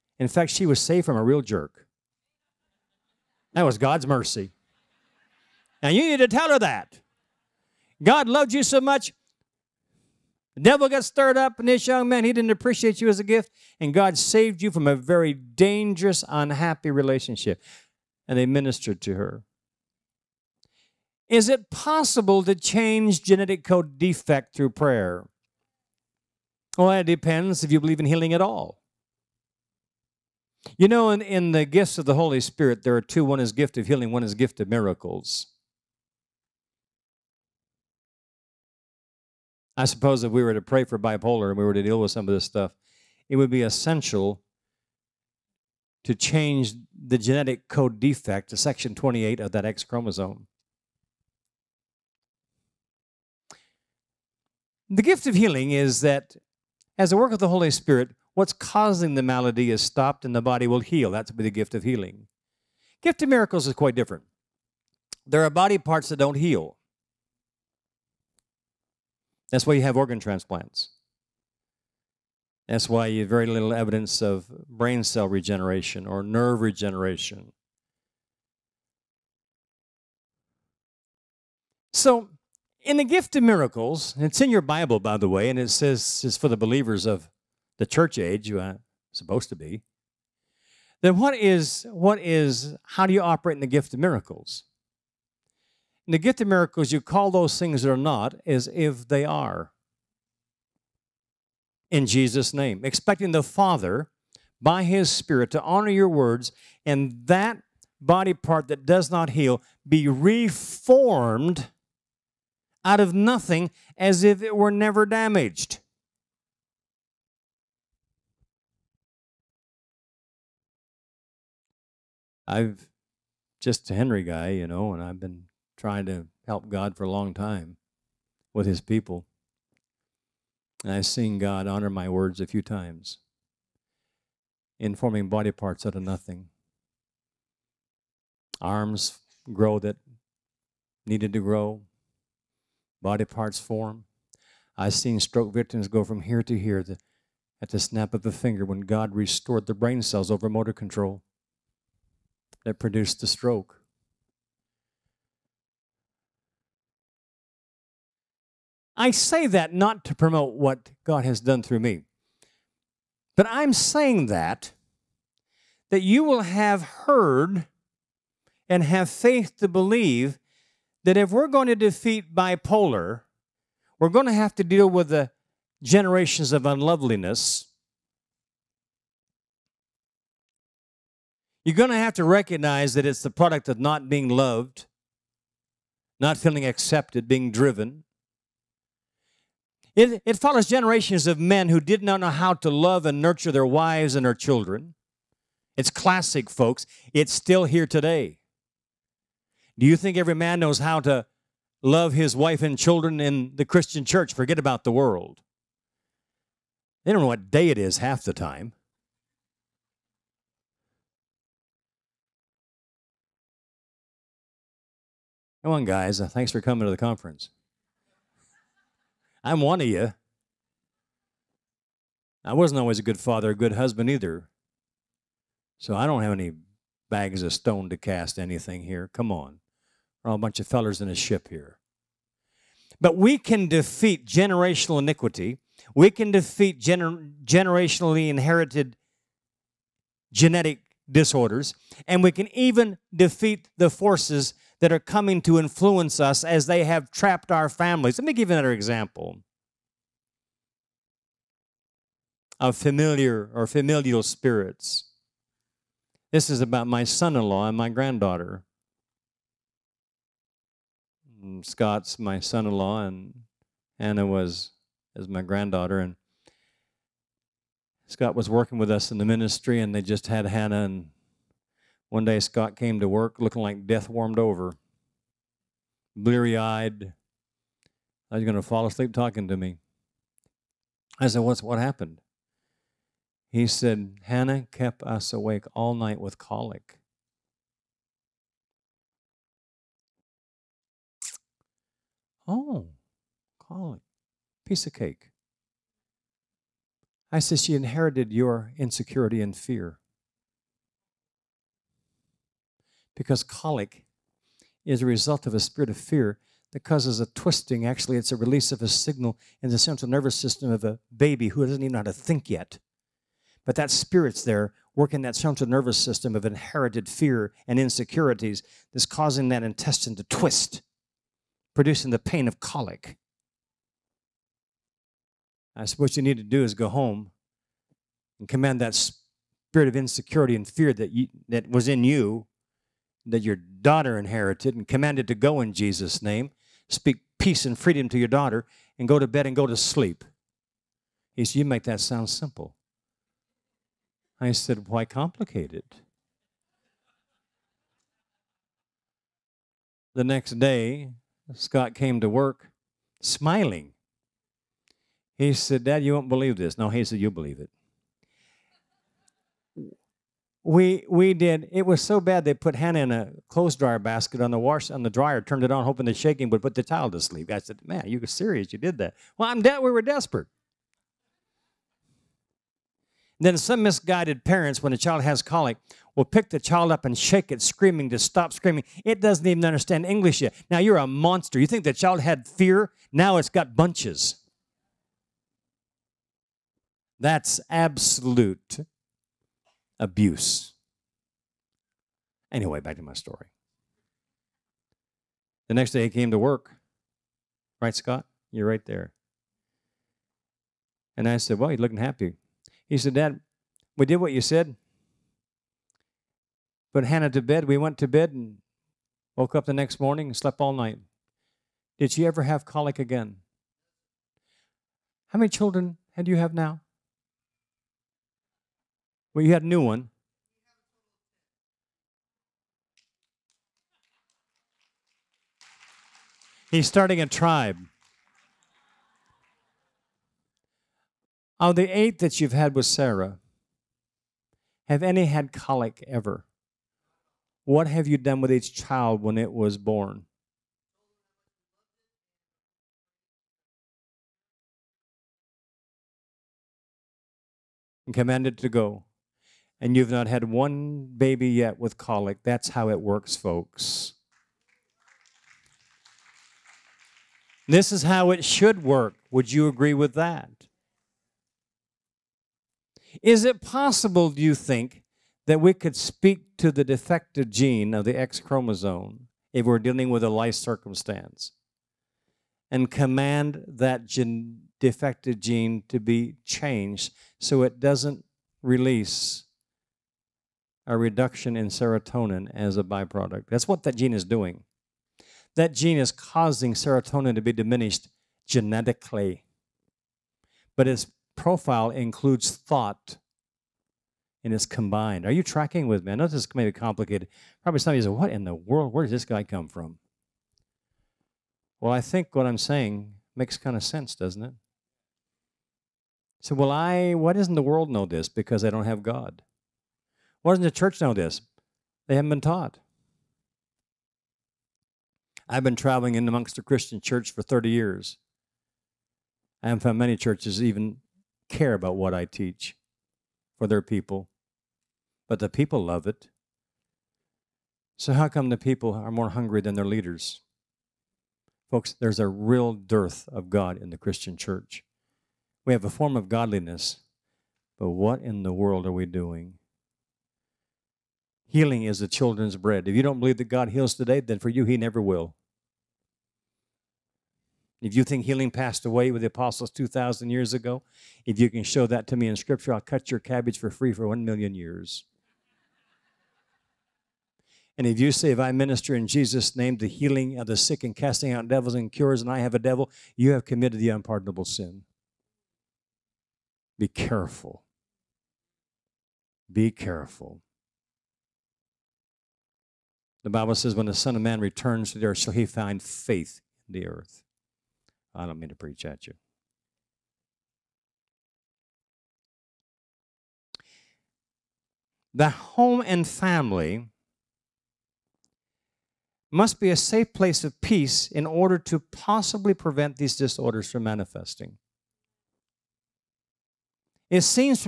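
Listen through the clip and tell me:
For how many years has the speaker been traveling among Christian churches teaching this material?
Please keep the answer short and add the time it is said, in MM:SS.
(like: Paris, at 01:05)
30 years, at 08:37.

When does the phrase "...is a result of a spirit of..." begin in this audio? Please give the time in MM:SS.
05:04.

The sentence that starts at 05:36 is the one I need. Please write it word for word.
Speak peace and freedom to your daughter and go to bed and go to sleep.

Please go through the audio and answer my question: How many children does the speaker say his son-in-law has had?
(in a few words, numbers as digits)
8.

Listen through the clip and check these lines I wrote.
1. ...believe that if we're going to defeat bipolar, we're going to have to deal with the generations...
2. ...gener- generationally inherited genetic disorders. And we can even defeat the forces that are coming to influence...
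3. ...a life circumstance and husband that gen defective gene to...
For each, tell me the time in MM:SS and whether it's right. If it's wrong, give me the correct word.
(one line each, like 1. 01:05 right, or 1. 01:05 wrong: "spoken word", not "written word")
1. 02:49 right
2. 03:56 right
3. 07:50 wrong: "command", not "husband".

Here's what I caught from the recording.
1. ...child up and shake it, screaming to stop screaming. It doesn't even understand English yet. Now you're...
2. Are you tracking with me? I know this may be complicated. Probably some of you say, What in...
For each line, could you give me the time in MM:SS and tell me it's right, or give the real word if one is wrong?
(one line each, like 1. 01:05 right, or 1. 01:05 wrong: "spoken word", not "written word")
1. 06:16 right
2. 08:15 right.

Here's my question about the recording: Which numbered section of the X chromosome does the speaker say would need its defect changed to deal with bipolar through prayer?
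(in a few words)
Section 28.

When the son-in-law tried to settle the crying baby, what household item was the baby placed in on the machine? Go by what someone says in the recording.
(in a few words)
Clothes dryer basket.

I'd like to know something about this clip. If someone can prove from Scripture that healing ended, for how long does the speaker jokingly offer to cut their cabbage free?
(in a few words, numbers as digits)
1 million years.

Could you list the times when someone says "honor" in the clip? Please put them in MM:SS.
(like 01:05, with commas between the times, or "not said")
01:45, 02:11.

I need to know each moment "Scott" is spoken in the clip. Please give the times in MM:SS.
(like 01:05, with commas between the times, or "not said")
04:21, 04:28, 04:32, 05:51, 06:37.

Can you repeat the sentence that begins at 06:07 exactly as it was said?
I said, "Man, you were serious.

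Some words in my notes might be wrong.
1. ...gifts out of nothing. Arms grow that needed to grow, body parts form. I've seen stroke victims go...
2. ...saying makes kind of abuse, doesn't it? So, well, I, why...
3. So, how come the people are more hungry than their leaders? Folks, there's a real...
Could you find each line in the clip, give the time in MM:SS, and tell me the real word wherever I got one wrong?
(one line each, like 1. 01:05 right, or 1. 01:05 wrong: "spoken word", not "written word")
1. 02:15 wrong: "parts", not "gifts"
2. 08:22 wrong: "sense", not "abuse"
3. 08:47 right.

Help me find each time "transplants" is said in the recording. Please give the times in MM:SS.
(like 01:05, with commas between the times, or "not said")
01:10.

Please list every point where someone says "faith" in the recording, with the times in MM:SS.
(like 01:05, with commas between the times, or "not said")
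02:49, 09:35.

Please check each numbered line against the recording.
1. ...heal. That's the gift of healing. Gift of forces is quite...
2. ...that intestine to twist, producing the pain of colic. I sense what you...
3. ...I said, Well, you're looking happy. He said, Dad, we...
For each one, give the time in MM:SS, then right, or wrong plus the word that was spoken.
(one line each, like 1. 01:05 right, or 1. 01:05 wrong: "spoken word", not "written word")
1. 01:00 wrong: "miracles", not "forces"
2. 05:19 wrong: "suppose", not "sense"
3. 06:41 right.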